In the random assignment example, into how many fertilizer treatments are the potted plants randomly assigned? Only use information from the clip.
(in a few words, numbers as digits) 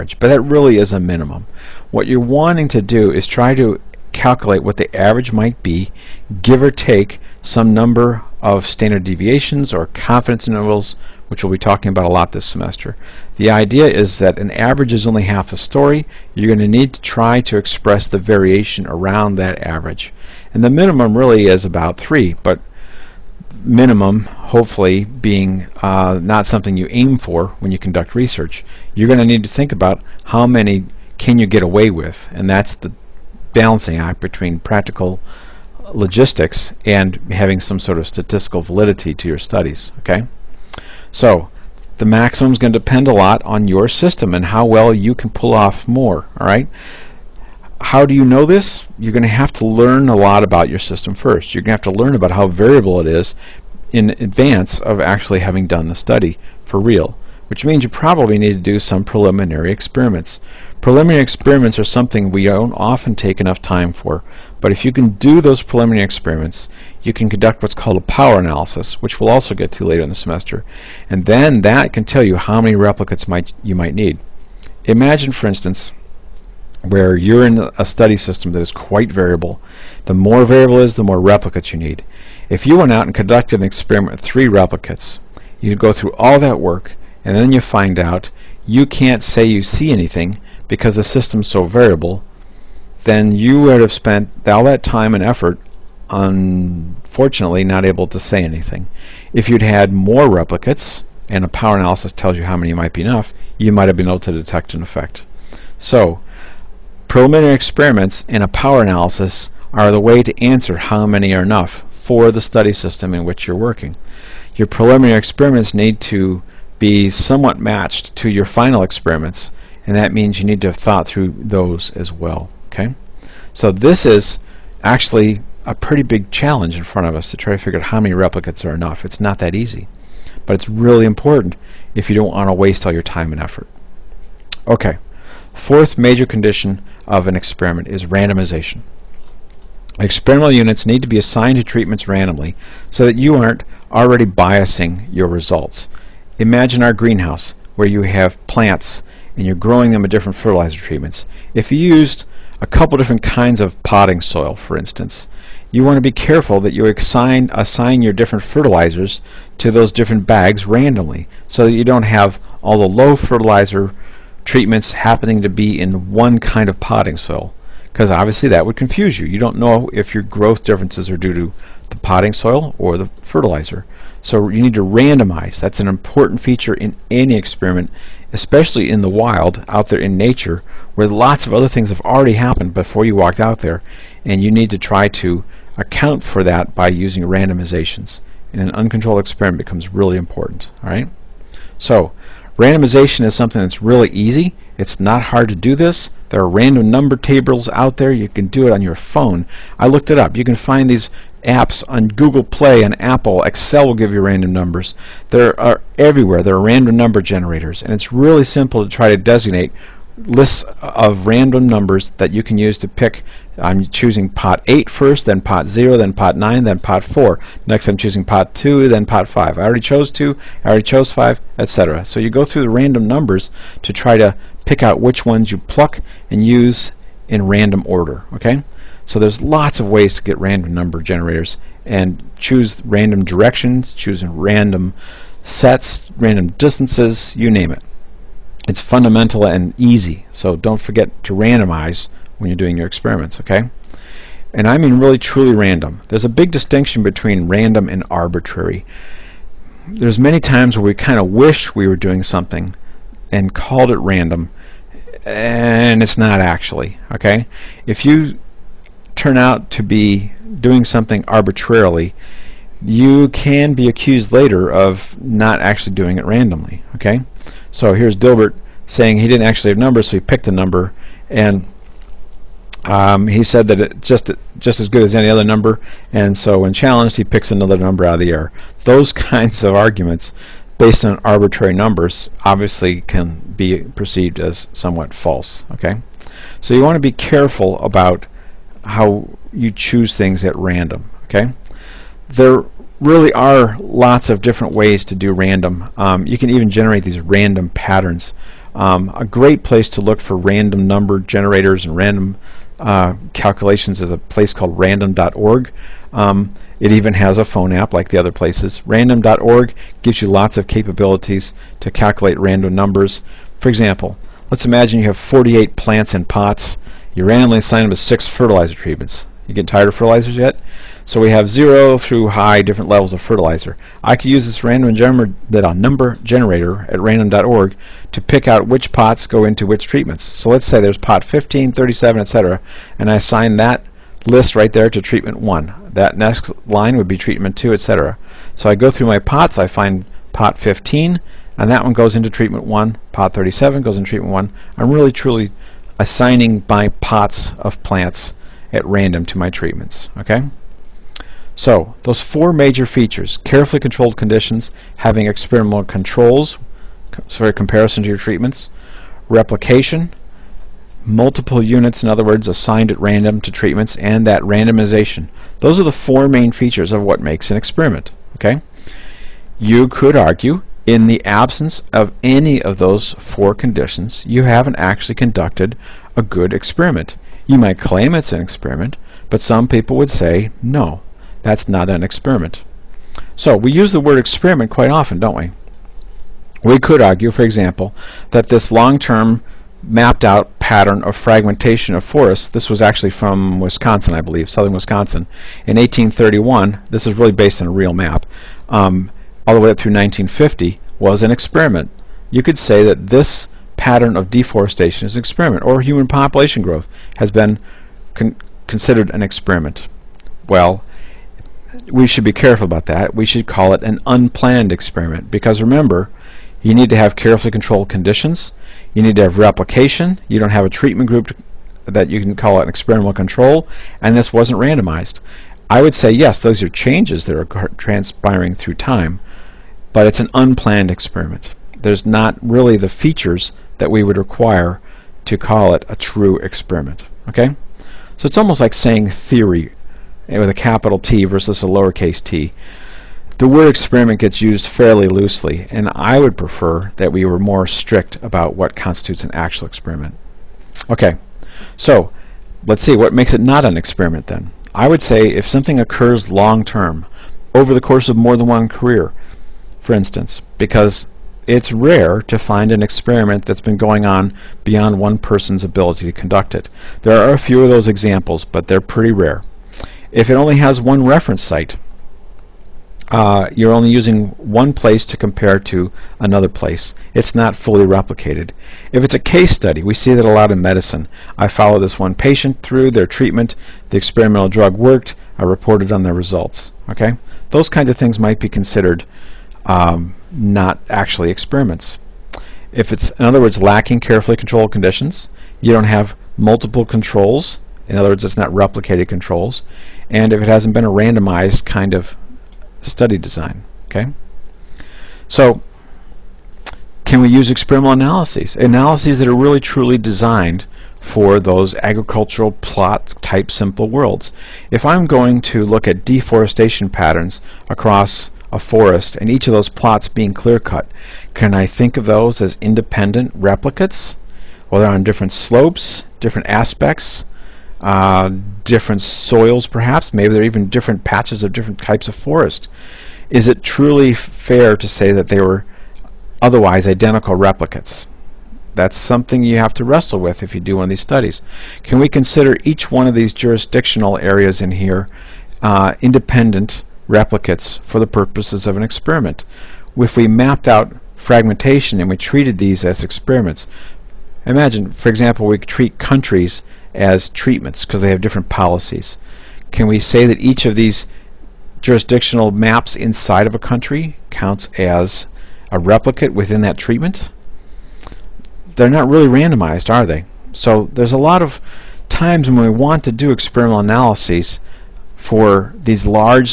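6.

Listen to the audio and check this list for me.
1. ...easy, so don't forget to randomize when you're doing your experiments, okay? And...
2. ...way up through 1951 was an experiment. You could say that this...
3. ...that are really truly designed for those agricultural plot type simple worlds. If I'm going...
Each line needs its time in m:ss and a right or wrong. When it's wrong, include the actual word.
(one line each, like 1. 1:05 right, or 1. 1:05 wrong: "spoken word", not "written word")
1. 3:59 right
2. 6:39 wrong: "1950", not "1951"
3. 8:29 right.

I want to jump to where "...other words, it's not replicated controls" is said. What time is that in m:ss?
8:17.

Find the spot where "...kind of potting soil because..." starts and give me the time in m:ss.
2:46.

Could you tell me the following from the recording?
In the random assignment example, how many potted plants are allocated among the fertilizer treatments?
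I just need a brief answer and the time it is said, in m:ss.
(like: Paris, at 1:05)
48, at 5:15.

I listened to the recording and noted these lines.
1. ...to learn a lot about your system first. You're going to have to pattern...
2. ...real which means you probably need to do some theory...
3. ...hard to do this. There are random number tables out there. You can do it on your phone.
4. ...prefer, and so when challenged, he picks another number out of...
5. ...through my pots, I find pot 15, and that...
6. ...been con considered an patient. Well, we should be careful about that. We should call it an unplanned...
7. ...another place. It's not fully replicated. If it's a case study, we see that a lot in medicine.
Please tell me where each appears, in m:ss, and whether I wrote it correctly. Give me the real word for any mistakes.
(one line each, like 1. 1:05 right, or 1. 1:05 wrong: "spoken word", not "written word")
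1. 0:49 wrong: "learn", not "pattern"
2. 0:56 wrong: "preliminary", not "theory"
3. 3:15 right
4. 4:35 wrong: "number", not "prefer"
5. 5:38 right
6. 6:47 wrong: "experiment", not "patient"
7. 7:56 right.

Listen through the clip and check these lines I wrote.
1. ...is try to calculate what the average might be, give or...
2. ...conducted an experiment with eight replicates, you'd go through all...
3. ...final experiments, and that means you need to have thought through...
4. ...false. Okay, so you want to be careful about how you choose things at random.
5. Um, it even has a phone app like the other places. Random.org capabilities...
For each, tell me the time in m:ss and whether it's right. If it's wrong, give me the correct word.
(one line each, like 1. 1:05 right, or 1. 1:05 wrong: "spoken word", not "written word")
1. 0:03 right
2. 1:23 wrong: "three", not "eight"
3. 1:58 right
4. 4:45 right
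5. 5:06 wrong: "gives", not "capabilities".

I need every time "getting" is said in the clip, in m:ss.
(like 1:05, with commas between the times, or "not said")
5:19.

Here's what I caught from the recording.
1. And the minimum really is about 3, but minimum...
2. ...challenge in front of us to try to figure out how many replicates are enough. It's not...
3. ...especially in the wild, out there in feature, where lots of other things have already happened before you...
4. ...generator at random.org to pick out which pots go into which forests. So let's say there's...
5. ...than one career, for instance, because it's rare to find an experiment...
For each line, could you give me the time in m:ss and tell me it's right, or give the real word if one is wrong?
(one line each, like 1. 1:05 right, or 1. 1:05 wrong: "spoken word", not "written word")
1. 0:20 right
2. 2:06 right
3. 2:58 wrong: "nature", not "feature"
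4. 5:26 wrong: "treatments", not "forests"
5. 7:38 right.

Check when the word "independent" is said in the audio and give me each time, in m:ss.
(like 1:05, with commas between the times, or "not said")
8:42, 9:06.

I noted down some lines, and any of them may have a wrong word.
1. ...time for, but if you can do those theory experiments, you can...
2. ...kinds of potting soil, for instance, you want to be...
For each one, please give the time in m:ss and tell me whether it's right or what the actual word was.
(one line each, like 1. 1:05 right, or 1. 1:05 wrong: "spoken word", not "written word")
1. 1:03 wrong: "preliminary", not "theory"
2. 2:33 right.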